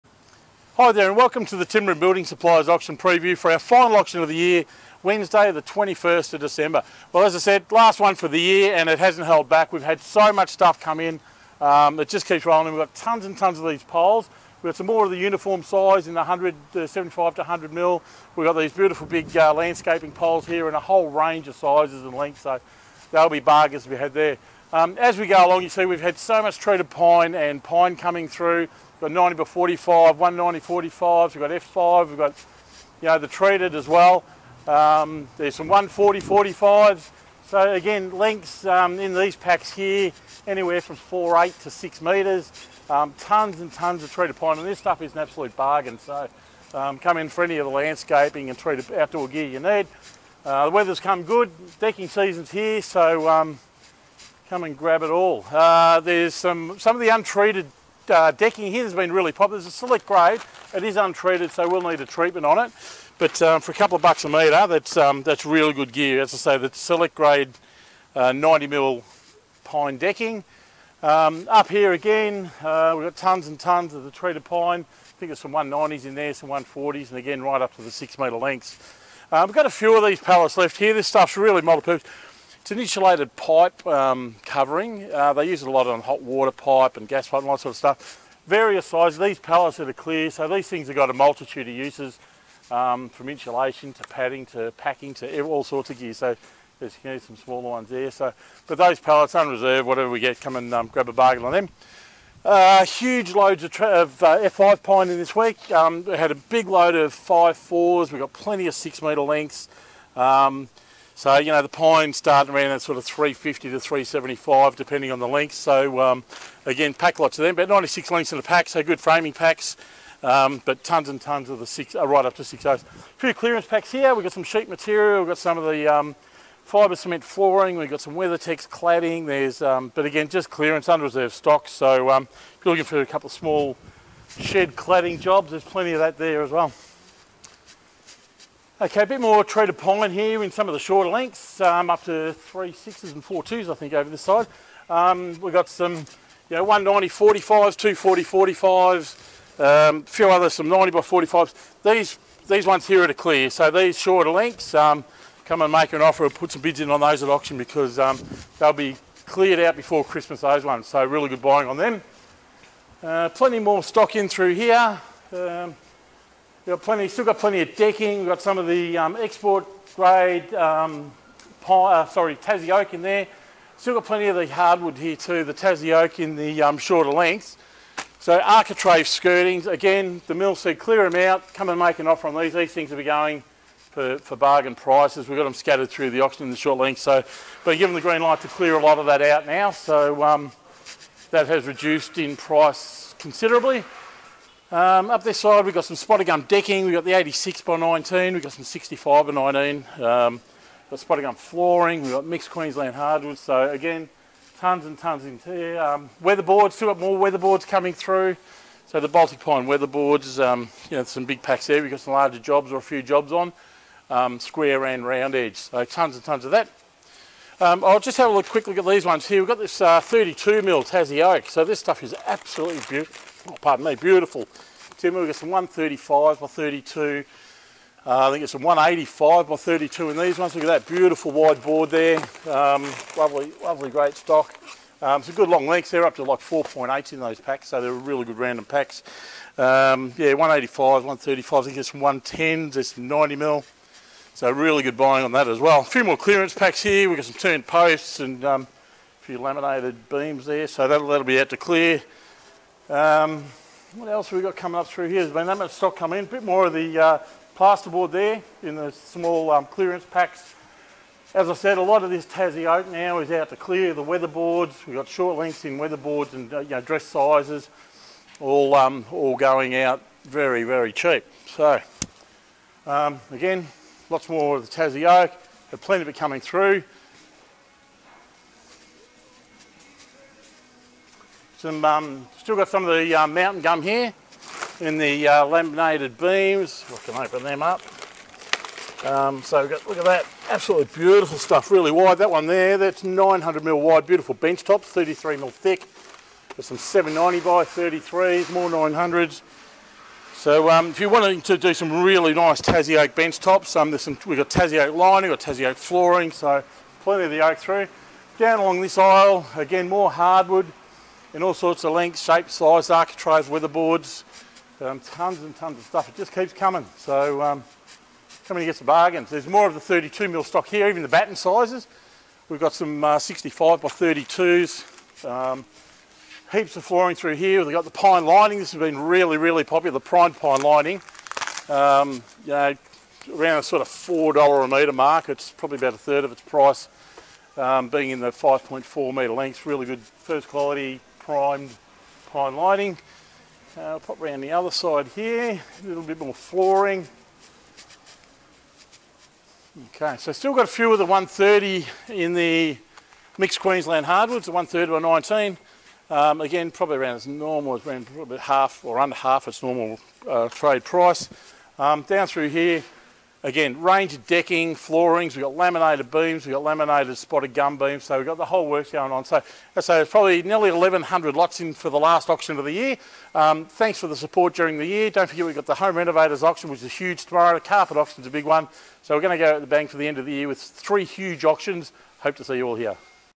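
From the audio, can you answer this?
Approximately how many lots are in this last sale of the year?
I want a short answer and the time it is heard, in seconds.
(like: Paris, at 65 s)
1,100, at 370 s.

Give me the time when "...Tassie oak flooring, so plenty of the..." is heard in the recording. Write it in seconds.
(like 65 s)
305 s.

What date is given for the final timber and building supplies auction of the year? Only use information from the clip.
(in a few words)
Wednesday 21 December.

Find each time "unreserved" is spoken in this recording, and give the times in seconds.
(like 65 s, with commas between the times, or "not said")
99 s, 130 s.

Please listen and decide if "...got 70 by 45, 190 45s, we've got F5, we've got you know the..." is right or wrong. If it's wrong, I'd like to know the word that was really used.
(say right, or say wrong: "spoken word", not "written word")
wrong: "90", not "70".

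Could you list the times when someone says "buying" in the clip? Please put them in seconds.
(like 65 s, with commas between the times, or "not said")
161 s, 244 s.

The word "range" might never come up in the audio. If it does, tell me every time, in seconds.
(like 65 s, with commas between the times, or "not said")
21 s, 363 s.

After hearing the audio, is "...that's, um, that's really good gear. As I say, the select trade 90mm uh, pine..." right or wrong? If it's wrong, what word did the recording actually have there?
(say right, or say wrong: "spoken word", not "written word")
wrong: "grade", not "trade".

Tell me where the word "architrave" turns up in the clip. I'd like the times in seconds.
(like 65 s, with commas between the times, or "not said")
178 s, 312 s.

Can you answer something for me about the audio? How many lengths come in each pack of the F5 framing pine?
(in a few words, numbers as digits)
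96.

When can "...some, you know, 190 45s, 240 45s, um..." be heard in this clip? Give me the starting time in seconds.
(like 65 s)
145 s.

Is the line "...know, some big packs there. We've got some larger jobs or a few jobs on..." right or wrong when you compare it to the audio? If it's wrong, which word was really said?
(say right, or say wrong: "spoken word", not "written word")
right.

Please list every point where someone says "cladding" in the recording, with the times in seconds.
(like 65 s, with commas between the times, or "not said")
128 s, 134 s.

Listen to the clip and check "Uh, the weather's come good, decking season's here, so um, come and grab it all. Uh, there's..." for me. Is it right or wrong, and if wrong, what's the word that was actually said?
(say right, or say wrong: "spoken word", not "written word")
right.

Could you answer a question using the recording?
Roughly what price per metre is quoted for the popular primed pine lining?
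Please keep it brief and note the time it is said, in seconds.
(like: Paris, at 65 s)
$4, at 333 s.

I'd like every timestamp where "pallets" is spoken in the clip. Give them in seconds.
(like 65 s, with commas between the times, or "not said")
80 s, 89 s, 98 s.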